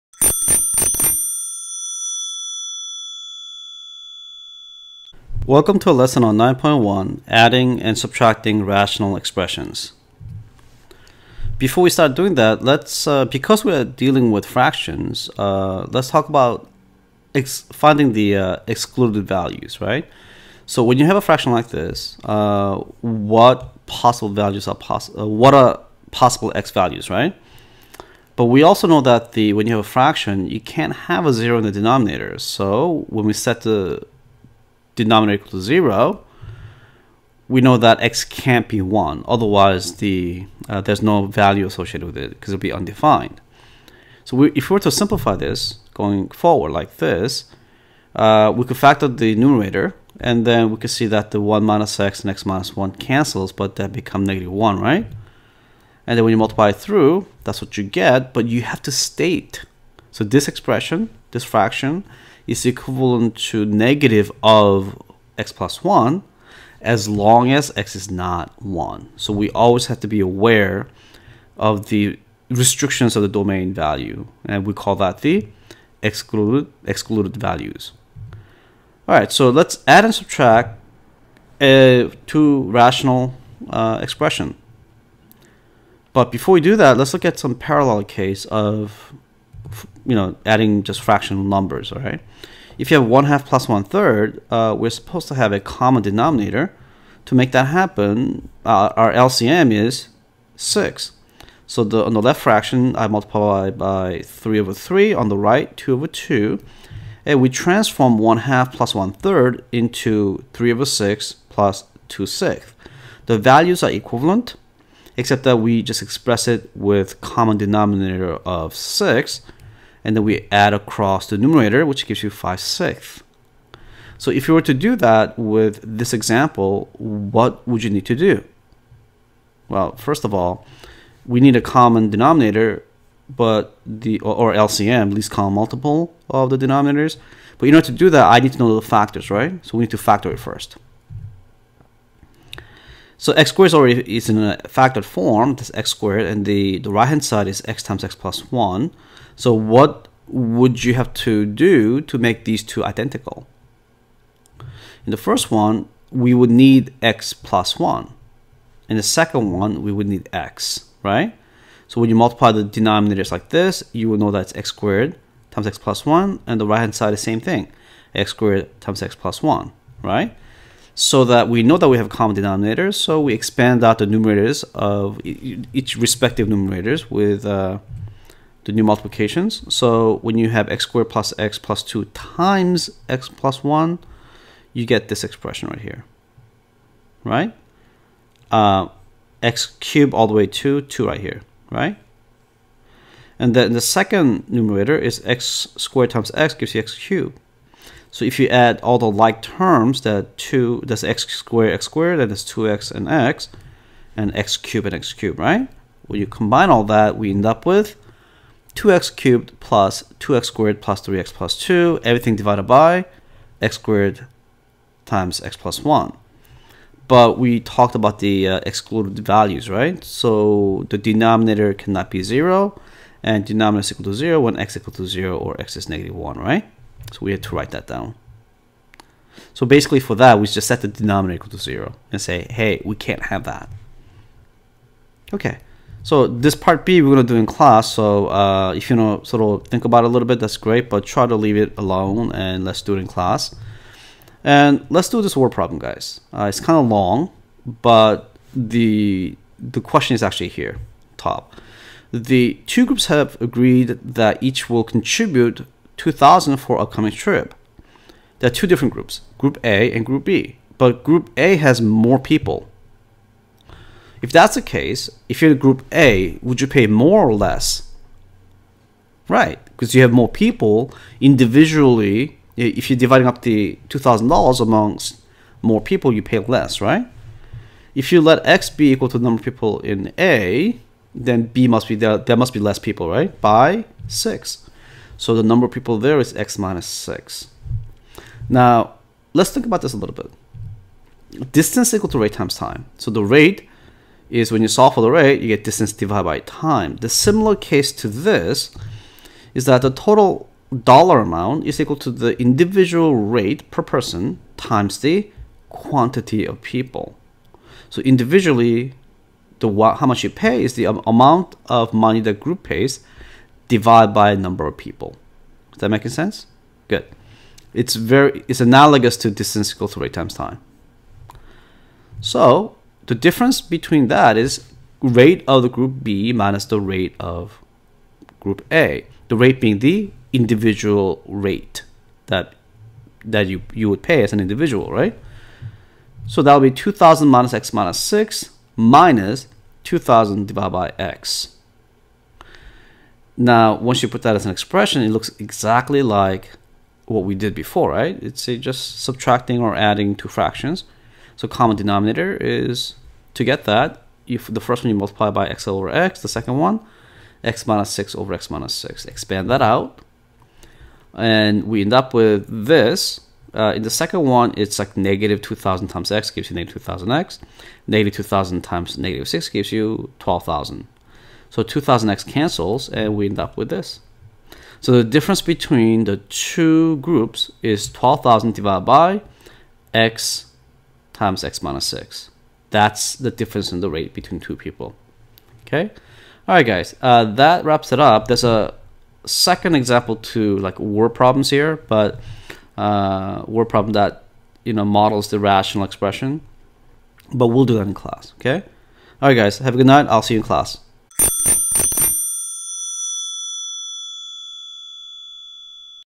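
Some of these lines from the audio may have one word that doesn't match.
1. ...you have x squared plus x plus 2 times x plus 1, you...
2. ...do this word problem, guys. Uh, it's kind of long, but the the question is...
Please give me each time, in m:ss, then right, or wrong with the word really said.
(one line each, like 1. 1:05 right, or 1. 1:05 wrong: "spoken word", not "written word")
1. 3:00 right
2. 4:05 right.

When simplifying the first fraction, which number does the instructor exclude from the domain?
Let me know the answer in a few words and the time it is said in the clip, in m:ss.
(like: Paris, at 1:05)
1, at 0:38.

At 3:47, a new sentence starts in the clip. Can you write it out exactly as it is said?
So we had to write that down.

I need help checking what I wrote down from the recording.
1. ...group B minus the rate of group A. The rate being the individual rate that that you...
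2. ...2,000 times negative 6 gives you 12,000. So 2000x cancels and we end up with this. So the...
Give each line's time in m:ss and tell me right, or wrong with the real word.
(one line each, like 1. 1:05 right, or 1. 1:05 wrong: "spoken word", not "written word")
1. 5:25 right
2. 6:08 right.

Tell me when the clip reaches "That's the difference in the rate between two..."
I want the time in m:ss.
6:22.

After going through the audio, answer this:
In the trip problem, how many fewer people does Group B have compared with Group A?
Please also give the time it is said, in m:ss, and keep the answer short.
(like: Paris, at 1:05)
6, at 4:43.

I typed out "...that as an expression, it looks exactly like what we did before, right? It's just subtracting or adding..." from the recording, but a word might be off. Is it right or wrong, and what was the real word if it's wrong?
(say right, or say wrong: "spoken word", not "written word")
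right.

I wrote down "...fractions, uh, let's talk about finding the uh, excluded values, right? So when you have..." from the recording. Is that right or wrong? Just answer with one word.
right.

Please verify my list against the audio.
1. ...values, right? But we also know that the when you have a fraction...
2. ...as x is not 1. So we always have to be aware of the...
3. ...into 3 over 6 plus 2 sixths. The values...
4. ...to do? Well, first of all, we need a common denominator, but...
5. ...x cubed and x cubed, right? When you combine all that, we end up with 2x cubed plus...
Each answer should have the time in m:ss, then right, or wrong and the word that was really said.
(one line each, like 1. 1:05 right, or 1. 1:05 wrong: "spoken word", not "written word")
1. 0:26 right
2. 1:07 right
3. 1:49 right
4. 2:08 right
5. 3:24 right.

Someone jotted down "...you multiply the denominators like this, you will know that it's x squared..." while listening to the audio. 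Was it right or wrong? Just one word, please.
right.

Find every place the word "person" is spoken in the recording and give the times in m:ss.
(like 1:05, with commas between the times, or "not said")
5:03.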